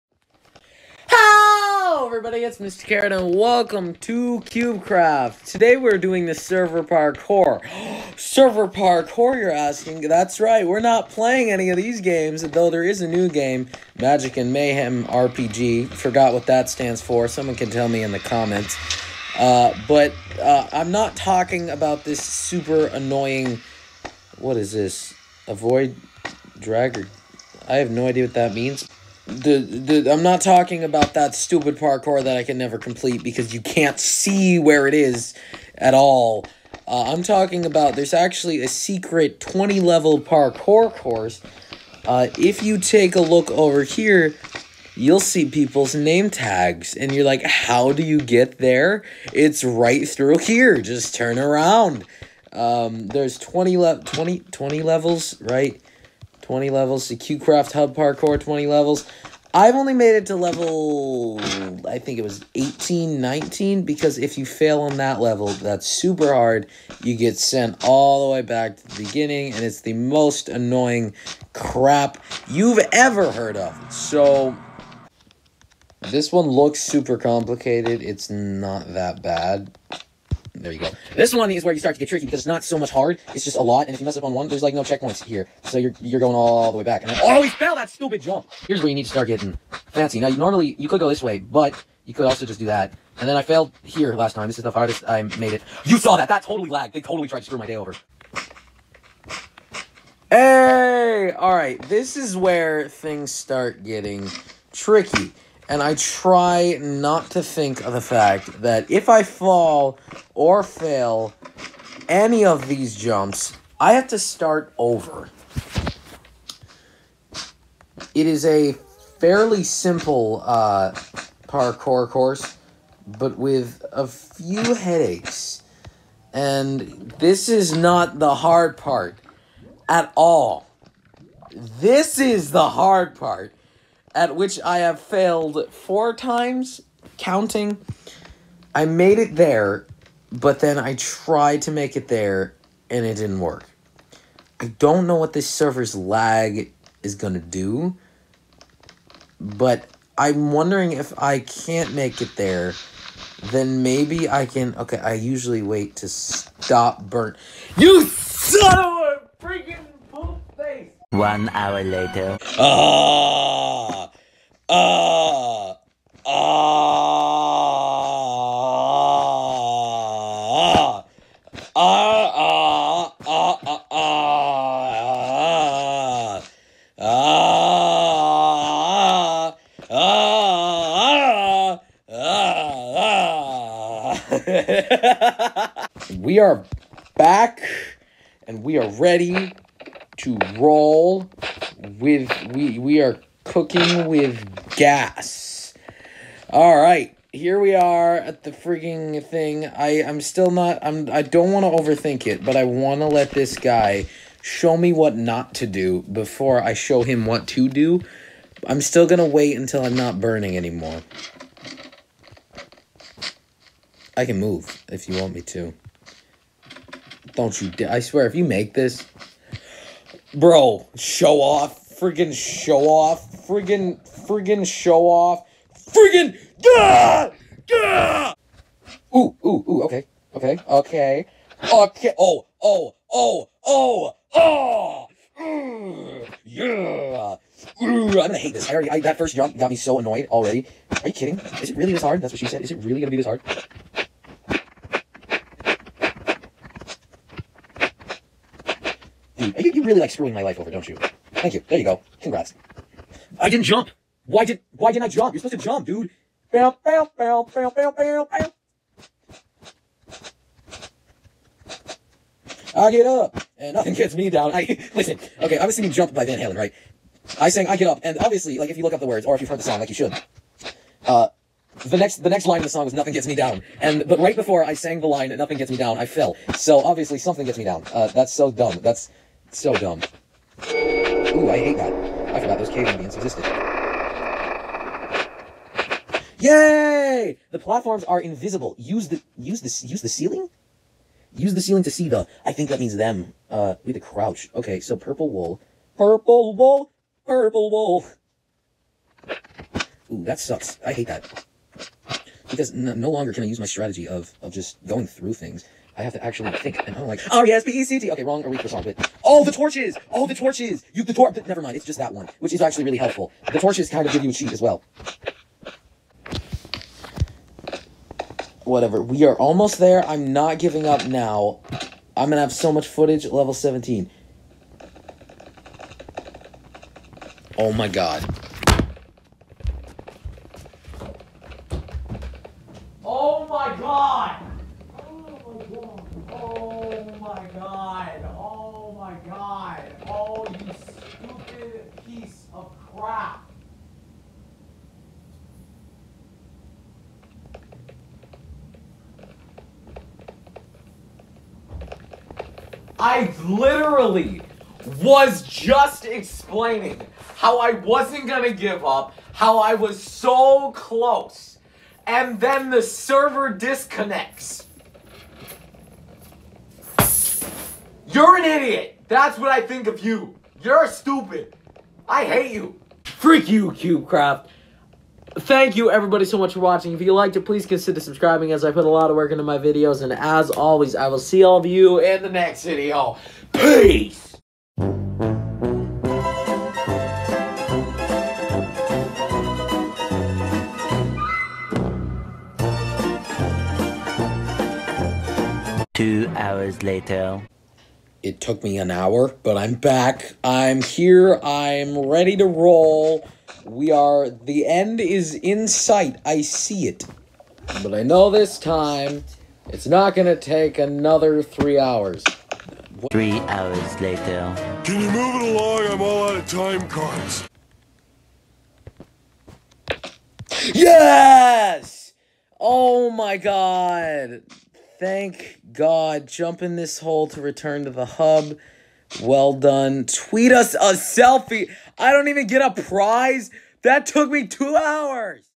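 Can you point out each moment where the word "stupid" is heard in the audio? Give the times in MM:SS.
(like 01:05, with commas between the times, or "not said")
00:31, 01:27, 06:10.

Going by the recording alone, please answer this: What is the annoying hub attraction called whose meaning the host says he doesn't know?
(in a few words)
Avoid dragger.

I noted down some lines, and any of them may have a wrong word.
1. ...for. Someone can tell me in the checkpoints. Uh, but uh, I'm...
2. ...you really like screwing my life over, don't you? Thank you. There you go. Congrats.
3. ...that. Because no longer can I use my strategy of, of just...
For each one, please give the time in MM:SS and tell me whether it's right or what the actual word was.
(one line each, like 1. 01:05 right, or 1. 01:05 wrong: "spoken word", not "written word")
1. 00:17 wrong: "comments", not "checkpoints"
2. 04:09 right
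3. 05:01 right.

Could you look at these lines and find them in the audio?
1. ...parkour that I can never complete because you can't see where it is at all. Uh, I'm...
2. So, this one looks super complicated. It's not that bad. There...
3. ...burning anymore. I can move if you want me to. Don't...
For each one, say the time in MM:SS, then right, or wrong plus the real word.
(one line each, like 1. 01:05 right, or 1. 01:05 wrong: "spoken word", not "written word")
1. 00:31 right
2. 01:13 right
3. 03:30 right.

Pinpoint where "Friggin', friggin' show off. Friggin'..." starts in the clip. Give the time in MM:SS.
03:43.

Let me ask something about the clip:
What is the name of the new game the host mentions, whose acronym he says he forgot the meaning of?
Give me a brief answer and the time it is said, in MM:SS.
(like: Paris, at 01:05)
Magic and Mayhem RPG, at 00:13.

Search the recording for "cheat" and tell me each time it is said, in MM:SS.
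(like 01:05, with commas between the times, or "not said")
05:14.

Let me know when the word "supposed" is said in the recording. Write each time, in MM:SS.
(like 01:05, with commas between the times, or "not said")
04:15.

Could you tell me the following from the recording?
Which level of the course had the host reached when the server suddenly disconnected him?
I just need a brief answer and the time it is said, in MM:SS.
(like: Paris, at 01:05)
17, at 05:23.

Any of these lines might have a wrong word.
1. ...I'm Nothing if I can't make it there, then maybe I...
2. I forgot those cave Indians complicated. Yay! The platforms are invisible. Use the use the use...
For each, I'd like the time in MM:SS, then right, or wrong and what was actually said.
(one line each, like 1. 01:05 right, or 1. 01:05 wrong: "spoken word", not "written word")
1. 02:30 wrong: "wondering", not "Nothing"
2. 04:42 wrong: "existed", not "complicated".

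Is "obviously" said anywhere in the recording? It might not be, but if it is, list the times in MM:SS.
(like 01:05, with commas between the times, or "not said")
04:28, 04:36.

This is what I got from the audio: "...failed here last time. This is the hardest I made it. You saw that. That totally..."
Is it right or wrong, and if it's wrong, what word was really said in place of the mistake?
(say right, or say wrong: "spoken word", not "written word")
right.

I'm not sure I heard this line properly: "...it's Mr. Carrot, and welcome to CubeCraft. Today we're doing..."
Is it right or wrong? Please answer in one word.
right.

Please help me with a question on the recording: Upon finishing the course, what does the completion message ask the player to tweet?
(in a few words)
A selfie.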